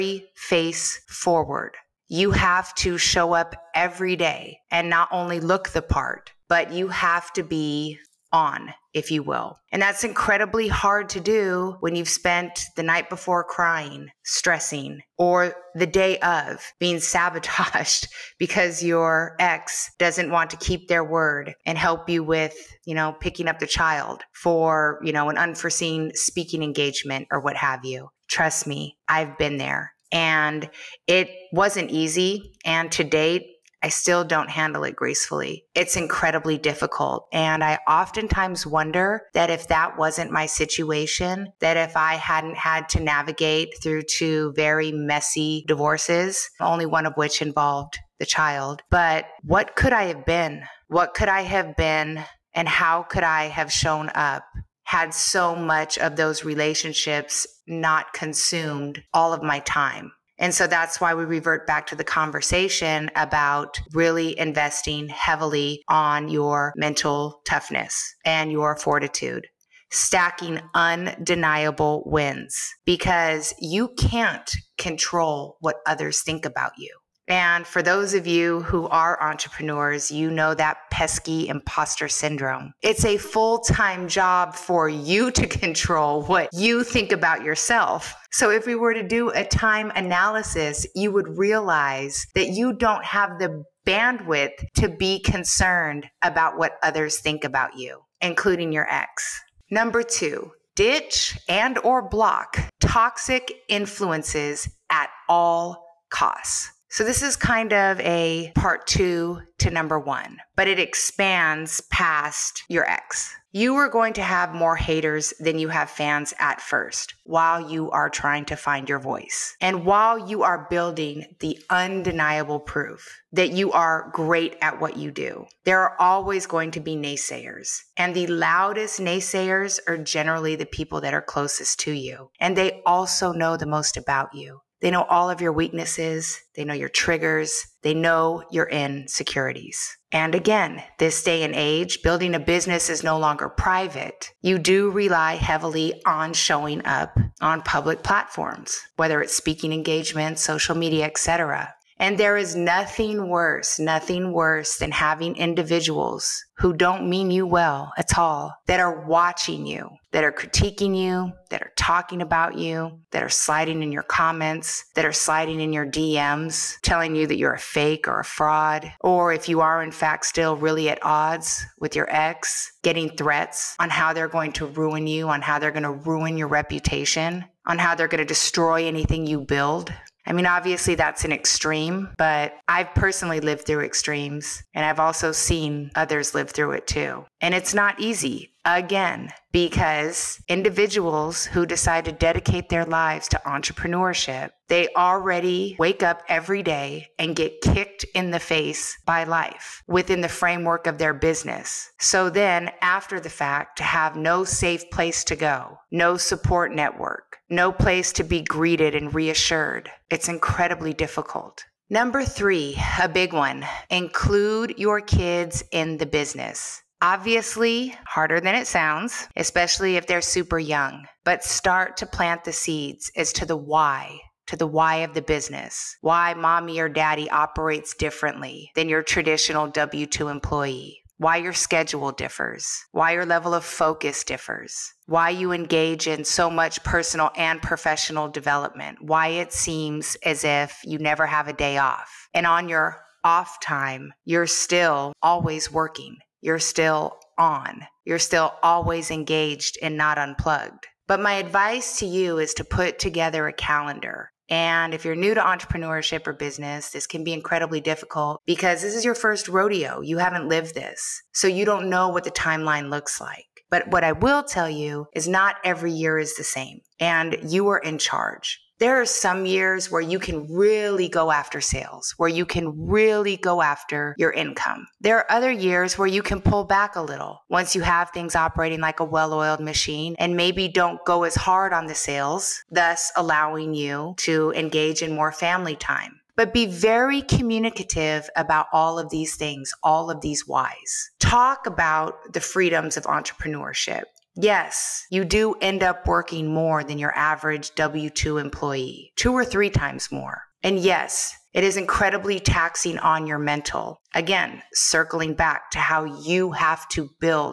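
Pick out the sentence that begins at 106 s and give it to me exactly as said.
So, this is kind of a part two to number one, but it expands past your ex.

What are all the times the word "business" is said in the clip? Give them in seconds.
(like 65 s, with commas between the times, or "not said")
142 s, 201 s, 216 s, 225 s, 256 s.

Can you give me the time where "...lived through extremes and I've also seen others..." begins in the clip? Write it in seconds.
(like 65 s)
183 s.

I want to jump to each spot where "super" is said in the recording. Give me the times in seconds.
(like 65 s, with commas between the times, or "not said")
220 s.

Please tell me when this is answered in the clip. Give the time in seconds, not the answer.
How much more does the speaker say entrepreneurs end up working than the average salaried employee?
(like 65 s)
299 s.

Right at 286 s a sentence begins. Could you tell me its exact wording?
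But be very communicative about all of these things, all of these whys.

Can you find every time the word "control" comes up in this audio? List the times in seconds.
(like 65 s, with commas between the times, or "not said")
74 s, 85 s.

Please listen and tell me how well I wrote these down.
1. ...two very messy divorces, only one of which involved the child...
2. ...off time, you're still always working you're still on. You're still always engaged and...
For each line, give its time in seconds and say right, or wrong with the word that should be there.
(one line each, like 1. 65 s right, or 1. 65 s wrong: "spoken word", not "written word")
1. 44 s right
2. 243 s right.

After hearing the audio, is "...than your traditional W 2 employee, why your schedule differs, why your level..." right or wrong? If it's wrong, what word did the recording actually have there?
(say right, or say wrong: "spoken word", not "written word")
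right.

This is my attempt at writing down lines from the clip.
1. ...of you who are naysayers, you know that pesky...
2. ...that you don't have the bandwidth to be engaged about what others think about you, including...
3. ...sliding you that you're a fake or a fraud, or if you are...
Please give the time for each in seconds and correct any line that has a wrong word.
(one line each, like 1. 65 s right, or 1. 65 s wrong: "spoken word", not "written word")
1. 78 s wrong: "entrepreneurs", not "naysayers"
2. 92 s wrong: "concerned", not "engaged"
3. 166 s wrong: "telling", not "sliding".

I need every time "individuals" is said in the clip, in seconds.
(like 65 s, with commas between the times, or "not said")
155 s, 190 s.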